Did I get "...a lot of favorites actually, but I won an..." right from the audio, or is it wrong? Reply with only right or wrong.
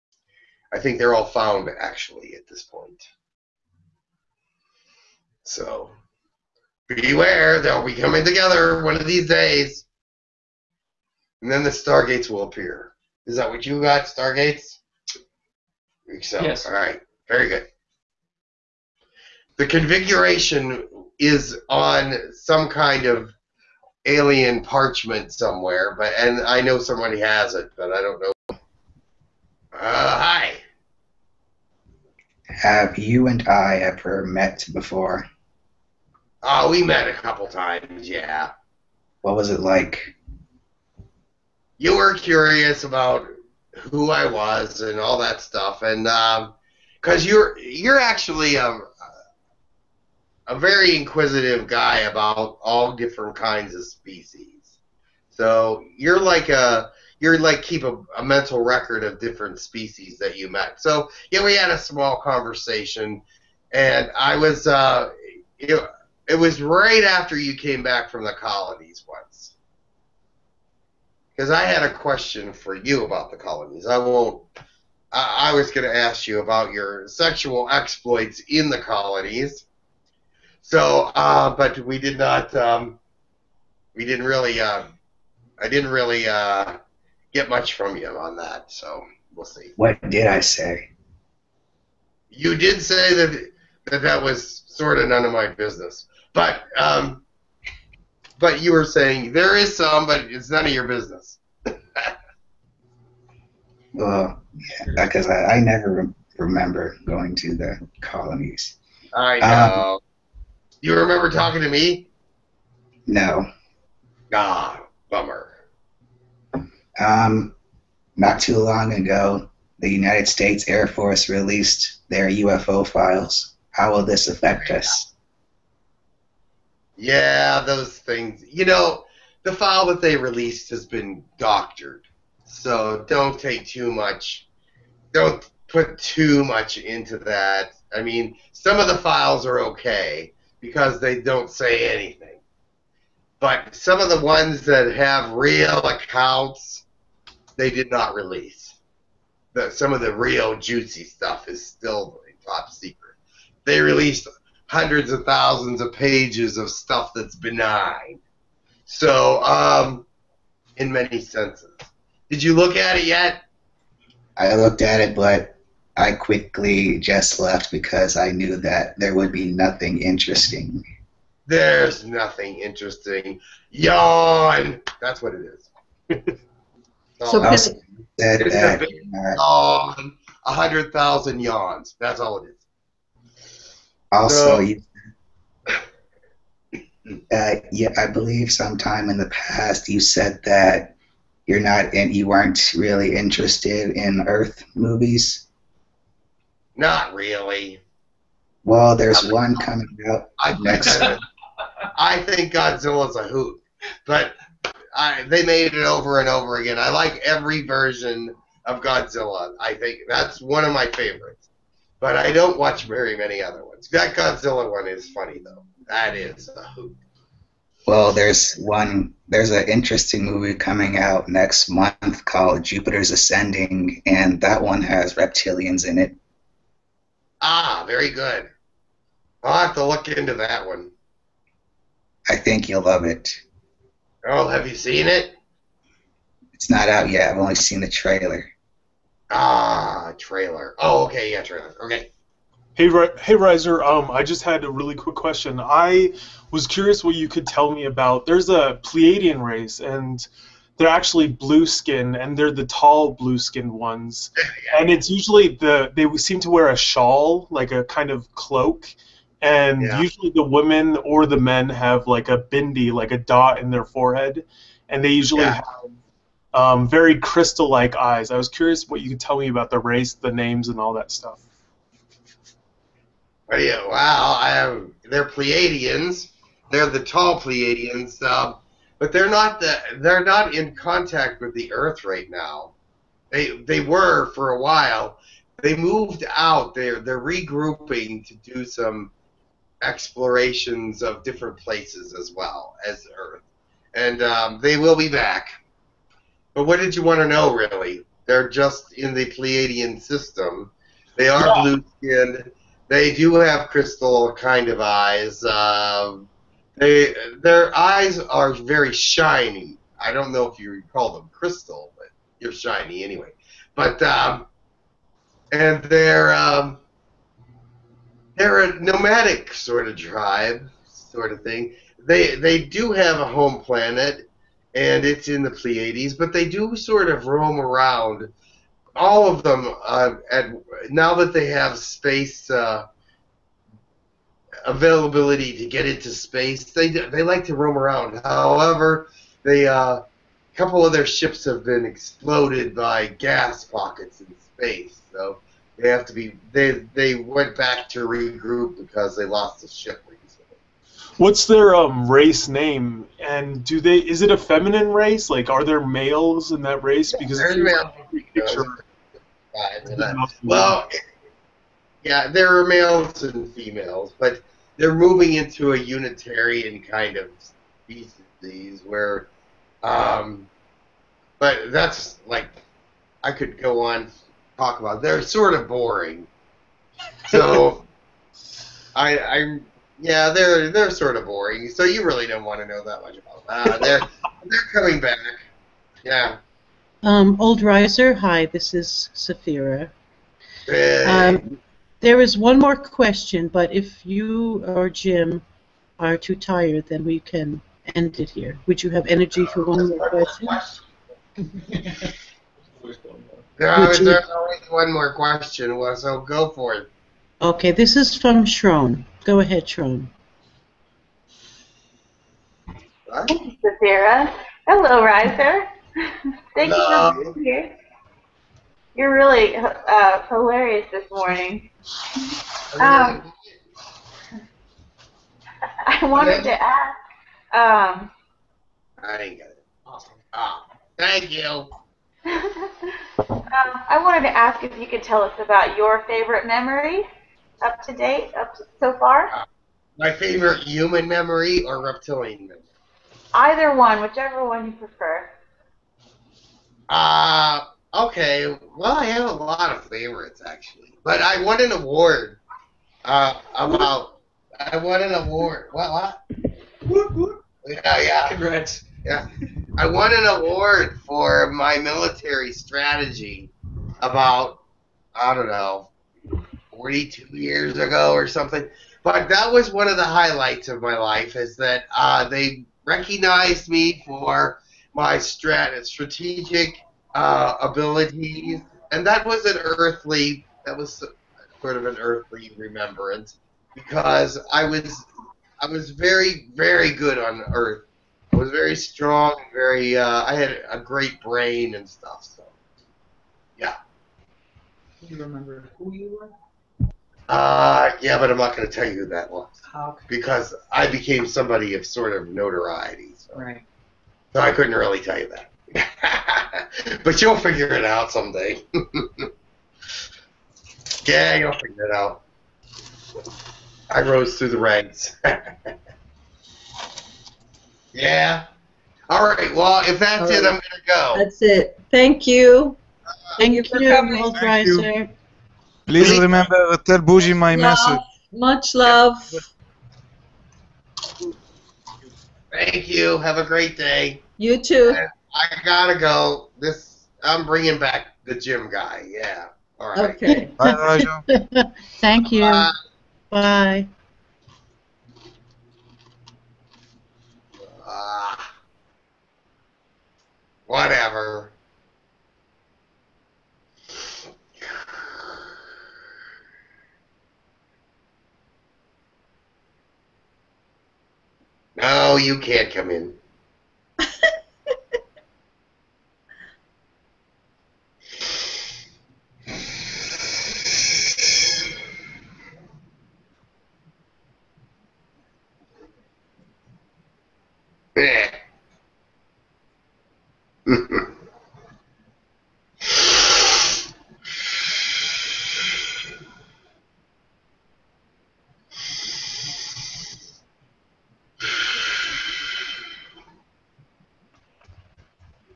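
right.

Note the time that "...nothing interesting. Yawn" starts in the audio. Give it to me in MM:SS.
02:52.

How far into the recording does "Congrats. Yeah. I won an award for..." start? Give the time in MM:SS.
07:38.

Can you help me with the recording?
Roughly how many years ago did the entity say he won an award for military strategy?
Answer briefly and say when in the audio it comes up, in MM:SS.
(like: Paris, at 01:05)
42, at 07:46.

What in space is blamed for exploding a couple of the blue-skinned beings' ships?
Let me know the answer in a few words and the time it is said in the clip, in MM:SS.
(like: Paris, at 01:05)
gas pockets, at 05:43.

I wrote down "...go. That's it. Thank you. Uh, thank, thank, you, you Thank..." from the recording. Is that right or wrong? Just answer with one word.
right.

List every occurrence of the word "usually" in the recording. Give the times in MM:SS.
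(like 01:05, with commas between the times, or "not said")
04:15, 04:19, 04:25.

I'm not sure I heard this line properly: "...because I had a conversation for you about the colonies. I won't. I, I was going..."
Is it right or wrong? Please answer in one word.
wrong.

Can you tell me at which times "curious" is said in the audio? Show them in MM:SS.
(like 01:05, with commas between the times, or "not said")
00:42, 04:06, 04:28.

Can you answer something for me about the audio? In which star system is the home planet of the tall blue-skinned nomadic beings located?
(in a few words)
Pleiades.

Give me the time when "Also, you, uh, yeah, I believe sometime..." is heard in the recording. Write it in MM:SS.
03:04.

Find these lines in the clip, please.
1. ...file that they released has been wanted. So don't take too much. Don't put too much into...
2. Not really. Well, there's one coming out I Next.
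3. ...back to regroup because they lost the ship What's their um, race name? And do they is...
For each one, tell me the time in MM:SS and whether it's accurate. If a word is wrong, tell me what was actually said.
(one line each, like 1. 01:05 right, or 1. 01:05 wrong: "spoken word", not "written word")
1. 02:09 wrong: "doctored", not "wanted"
2. 03:16 right
3. 05:47 right.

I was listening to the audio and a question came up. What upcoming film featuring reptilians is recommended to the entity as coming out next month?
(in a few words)
Jupiter's Ascending.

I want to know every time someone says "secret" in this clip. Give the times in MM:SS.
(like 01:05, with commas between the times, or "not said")
02:32.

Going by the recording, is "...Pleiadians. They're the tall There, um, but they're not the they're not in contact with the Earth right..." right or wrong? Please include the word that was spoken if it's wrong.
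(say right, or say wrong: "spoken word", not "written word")
wrong: "Pleiadians", not "There".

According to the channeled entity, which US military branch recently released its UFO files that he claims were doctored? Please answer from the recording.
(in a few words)
Air Force.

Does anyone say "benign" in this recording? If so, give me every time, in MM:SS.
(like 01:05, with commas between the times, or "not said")
02:37.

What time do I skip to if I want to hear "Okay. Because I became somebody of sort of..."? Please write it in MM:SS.
08:19.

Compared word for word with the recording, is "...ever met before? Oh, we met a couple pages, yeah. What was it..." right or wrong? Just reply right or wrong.
wrong.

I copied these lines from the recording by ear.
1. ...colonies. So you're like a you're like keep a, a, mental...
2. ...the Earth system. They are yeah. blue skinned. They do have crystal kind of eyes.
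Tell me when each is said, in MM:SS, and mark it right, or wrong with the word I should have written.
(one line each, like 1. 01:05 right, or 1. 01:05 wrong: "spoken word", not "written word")
1. 00:53 wrong: "species", not "colonies"
2. 04:59 wrong: "Pleiadian", not "Earth".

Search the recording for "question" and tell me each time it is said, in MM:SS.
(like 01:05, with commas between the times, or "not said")
01:11, 04:05, 06:32, 06:40, 06:45.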